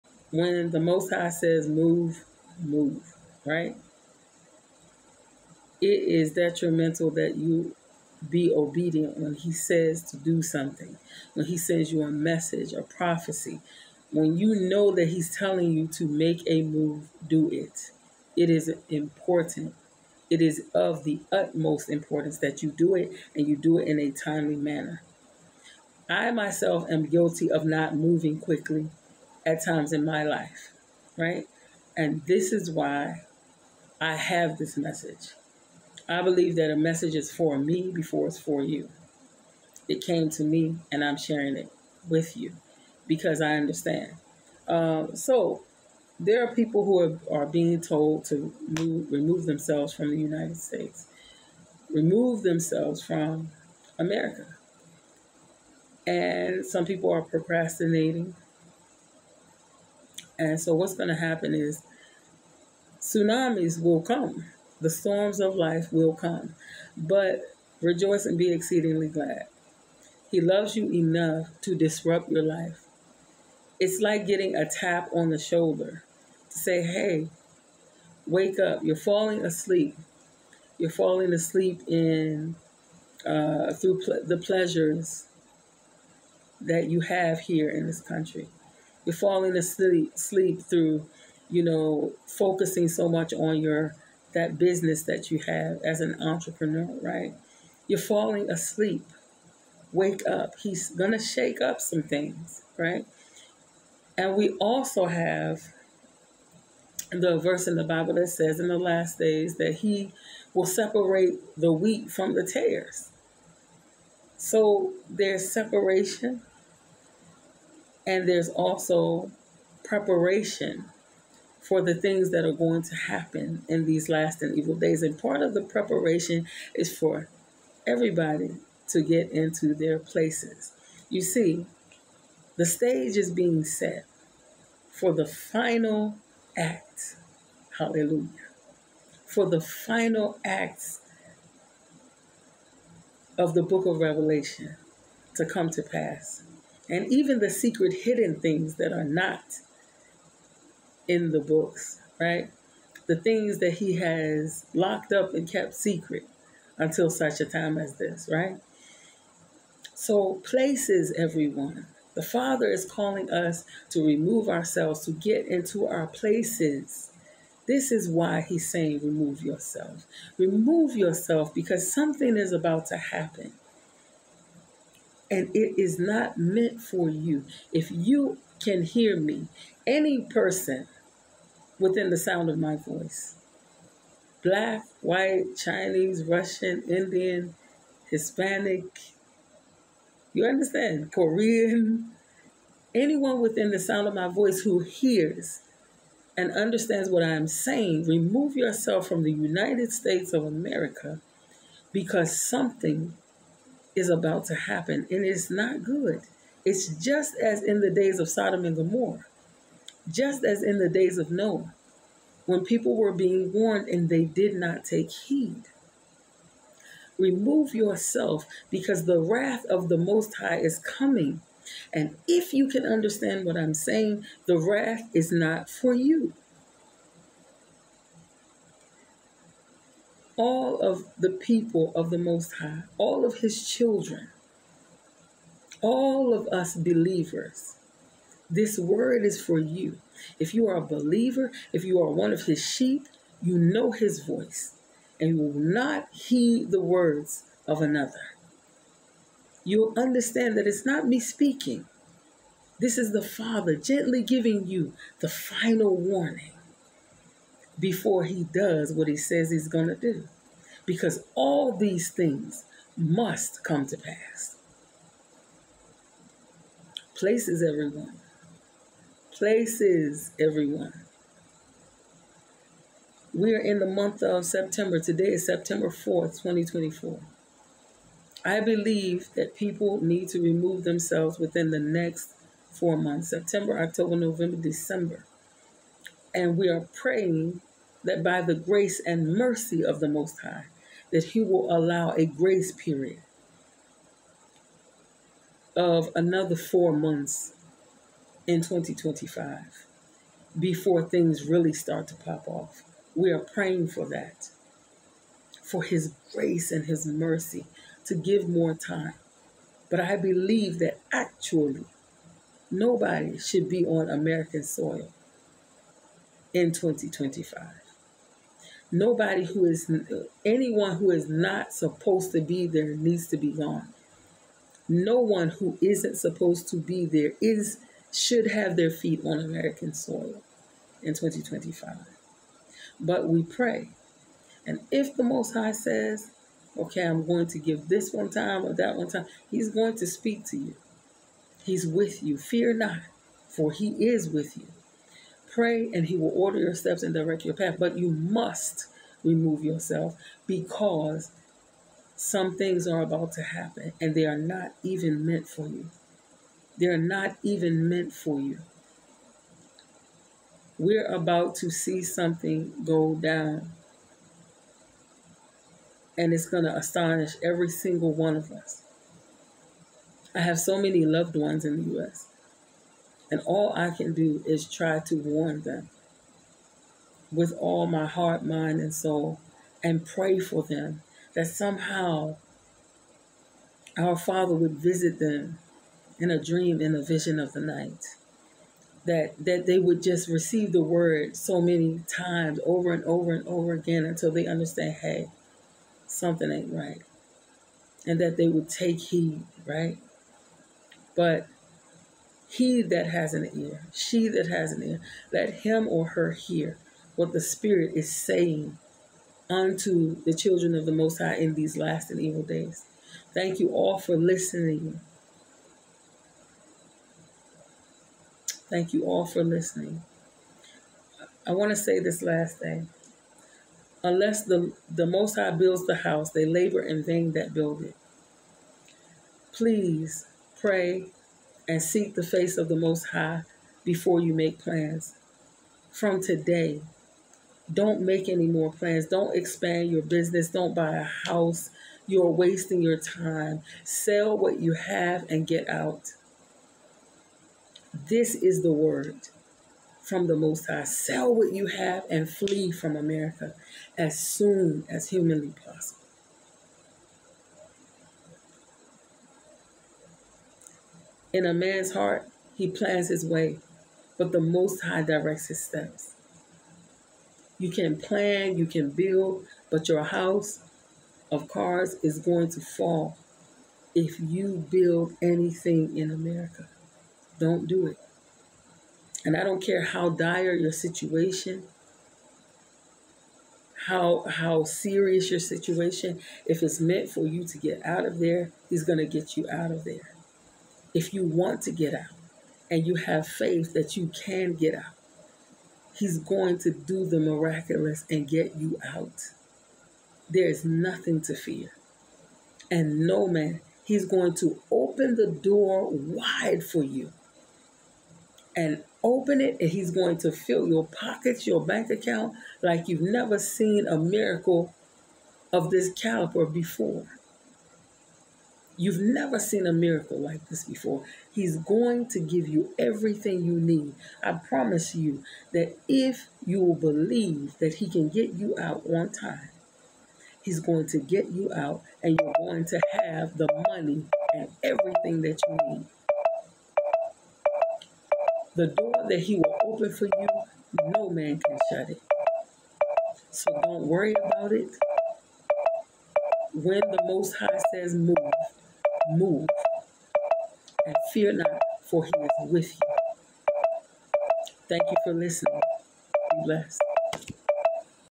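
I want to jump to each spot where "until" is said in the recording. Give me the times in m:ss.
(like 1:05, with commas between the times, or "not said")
2:36, 6:34.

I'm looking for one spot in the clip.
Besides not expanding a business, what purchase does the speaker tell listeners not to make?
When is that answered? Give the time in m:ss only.
7:20.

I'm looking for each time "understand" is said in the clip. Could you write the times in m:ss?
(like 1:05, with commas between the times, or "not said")
0:43, 3:10, 3:16, 3:42, 4:09, 6:34.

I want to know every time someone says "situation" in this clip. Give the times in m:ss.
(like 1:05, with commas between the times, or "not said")
8:00, 8:05.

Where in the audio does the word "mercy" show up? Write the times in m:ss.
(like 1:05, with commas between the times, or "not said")
4:49, 5:07.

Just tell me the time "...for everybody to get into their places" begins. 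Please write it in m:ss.
2:06.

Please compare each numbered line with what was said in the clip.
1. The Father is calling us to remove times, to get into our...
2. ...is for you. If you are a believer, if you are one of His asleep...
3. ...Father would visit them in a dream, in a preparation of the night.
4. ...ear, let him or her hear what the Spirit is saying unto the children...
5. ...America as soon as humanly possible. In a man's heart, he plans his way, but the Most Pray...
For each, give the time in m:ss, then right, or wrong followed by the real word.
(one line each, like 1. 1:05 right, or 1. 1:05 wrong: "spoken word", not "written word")
1. 2:42 wrong: "ourselves", not "times"
2. 3:59 wrong: "sheep", not "asleep"
3. 6:24 wrong: "vision", not "preparation"
4. 6:44 right
5. 7:32 wrong: "High", not "Pray".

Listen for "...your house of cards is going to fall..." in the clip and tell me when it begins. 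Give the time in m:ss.
7:49.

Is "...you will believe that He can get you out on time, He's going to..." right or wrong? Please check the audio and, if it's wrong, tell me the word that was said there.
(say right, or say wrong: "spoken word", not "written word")
right.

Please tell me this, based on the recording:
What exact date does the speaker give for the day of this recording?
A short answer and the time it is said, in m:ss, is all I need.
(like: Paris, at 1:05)
September 4th, 2024, at 4:35.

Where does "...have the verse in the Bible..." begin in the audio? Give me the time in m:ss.
1:45.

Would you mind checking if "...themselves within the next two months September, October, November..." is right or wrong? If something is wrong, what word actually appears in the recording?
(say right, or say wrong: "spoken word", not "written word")
wrong: "four", not "two".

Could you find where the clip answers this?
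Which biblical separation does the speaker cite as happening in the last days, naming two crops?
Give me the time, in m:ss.
1:51.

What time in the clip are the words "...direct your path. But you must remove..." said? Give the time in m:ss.
5:47.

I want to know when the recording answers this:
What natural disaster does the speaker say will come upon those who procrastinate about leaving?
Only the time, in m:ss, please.
1:02.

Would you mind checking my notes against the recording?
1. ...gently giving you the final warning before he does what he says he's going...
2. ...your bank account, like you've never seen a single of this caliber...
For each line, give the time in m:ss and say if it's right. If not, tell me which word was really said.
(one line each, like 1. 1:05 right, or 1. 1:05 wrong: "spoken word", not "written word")
1. 4:13 right
2. 8:31 wrong: "miracle", not "single".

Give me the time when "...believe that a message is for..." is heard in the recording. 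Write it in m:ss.
0:36.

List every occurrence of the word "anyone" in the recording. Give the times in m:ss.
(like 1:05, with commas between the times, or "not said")
3:12, 5:20.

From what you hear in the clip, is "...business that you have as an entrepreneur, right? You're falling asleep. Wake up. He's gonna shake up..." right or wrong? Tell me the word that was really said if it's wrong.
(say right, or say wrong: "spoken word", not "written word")
right.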